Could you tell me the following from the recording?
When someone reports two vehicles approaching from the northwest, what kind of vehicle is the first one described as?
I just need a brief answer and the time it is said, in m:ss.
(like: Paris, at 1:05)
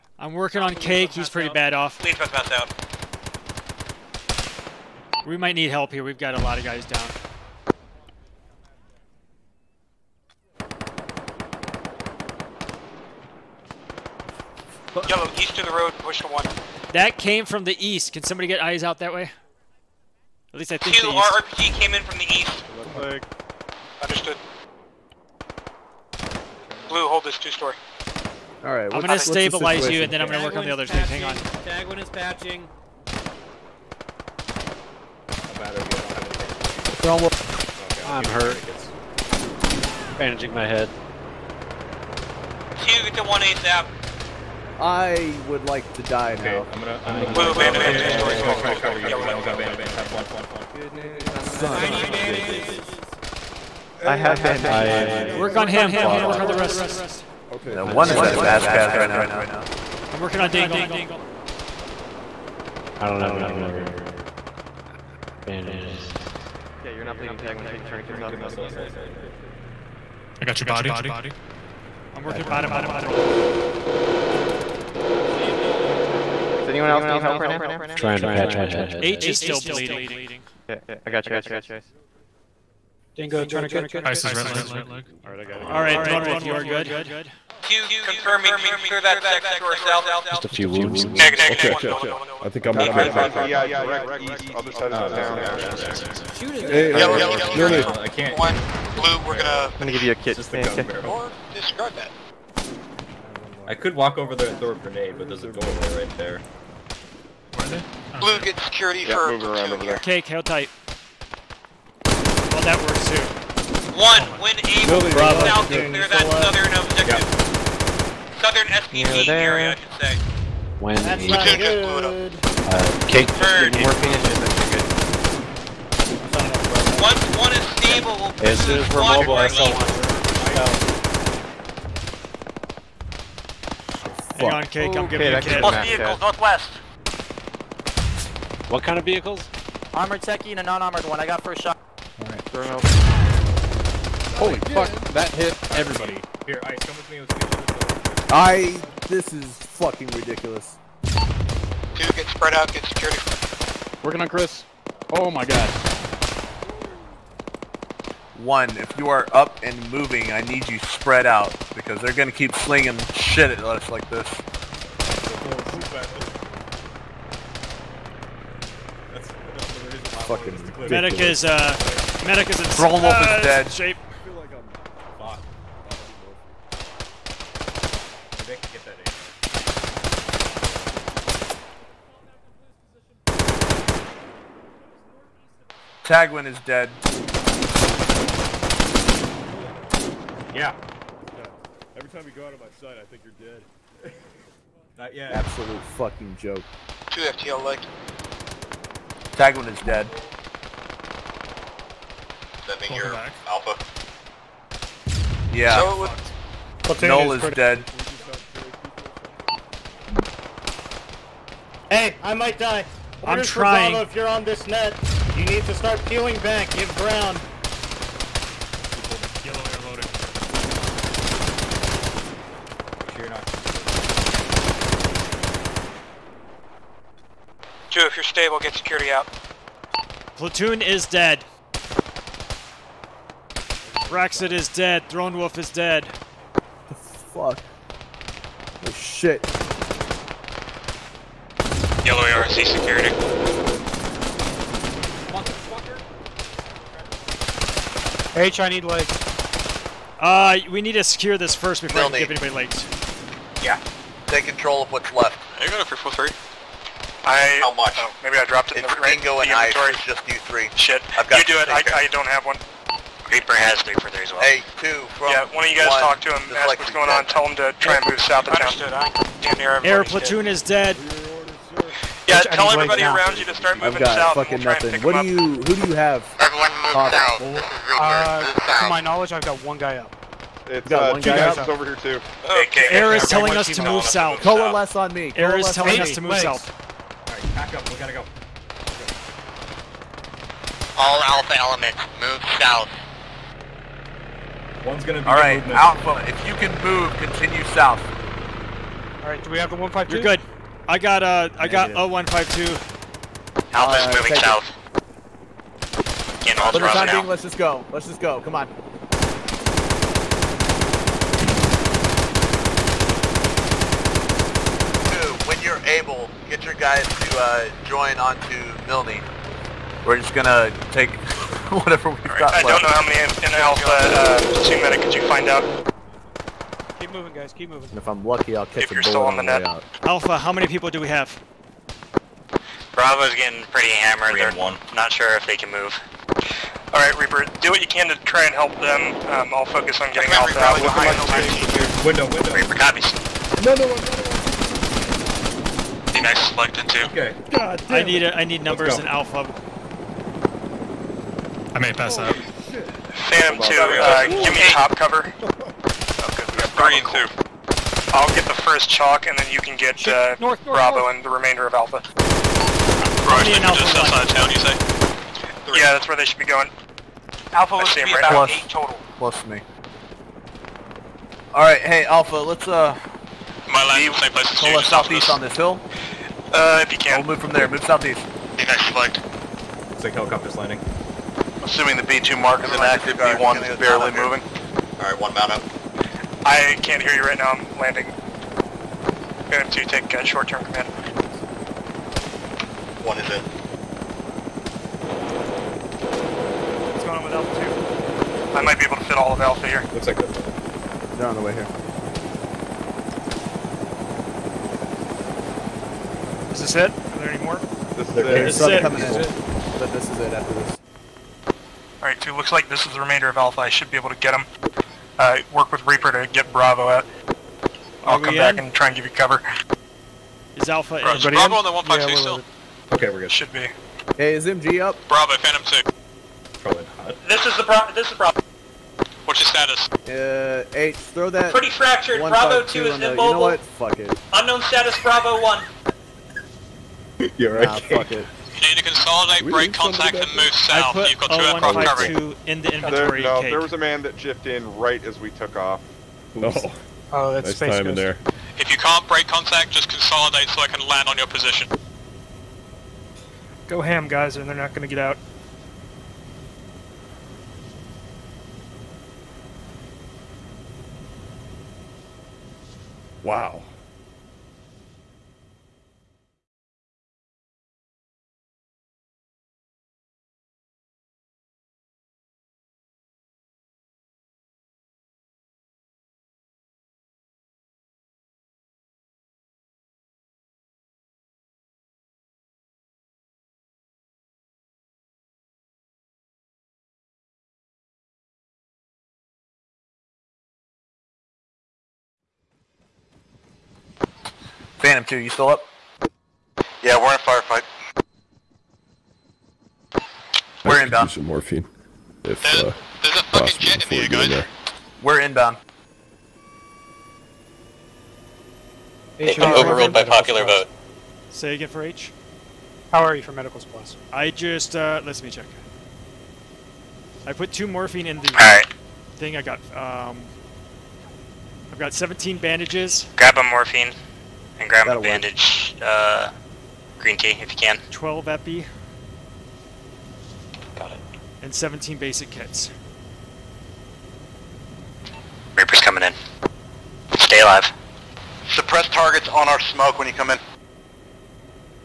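Armored techie, at 2:19.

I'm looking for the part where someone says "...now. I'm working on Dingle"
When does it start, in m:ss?
0:59.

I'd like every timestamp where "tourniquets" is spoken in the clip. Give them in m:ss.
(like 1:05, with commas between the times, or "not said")
1:07, 1:23.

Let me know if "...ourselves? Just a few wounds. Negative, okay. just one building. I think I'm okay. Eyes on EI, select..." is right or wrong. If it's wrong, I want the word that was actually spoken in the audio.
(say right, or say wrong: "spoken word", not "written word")
wrong: "direct", not "select".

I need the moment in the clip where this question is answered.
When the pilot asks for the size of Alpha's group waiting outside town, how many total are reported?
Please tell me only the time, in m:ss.
6:08.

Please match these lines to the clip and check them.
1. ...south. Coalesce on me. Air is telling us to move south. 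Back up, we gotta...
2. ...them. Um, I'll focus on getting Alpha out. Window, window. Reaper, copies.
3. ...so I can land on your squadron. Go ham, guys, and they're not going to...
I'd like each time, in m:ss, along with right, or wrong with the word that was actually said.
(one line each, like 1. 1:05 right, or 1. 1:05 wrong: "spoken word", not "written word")
1. 4:44 right
2. 5:38 right
3. 7:30 wrong: "position", not "squadron".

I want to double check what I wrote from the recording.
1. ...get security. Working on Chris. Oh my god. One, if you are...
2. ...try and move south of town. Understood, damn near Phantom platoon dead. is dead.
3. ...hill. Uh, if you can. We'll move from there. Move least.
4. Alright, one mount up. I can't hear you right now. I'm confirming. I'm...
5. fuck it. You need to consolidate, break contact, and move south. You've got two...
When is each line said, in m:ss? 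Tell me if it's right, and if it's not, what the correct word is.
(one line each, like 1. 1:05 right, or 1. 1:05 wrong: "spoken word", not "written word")
1. 2:32 right
2. 4:27 wrong: "Air", not "Phantom"
3. 6:15 wrong: "southeast", not "least"
4. 6:24 wrong: "landing", not "confirming"
5. 7:17 right.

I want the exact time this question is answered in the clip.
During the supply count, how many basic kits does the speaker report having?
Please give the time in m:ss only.
8:51.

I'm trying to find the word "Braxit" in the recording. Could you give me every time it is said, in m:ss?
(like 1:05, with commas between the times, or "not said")
3:54.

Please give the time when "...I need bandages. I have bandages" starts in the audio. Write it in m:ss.
0:51.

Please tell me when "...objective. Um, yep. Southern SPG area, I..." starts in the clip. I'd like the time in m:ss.
1:56.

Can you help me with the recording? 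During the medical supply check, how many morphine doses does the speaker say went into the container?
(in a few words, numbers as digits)
2.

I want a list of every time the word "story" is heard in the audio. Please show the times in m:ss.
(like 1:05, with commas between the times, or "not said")
0:27.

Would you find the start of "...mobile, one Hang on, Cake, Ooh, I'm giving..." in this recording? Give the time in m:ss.
2:10.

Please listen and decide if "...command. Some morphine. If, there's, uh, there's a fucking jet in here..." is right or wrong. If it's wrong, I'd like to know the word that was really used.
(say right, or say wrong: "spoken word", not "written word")
wrong: "inbound", not "command".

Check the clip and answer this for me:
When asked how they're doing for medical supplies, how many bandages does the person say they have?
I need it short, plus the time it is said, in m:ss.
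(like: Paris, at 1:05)
17, at 8:41.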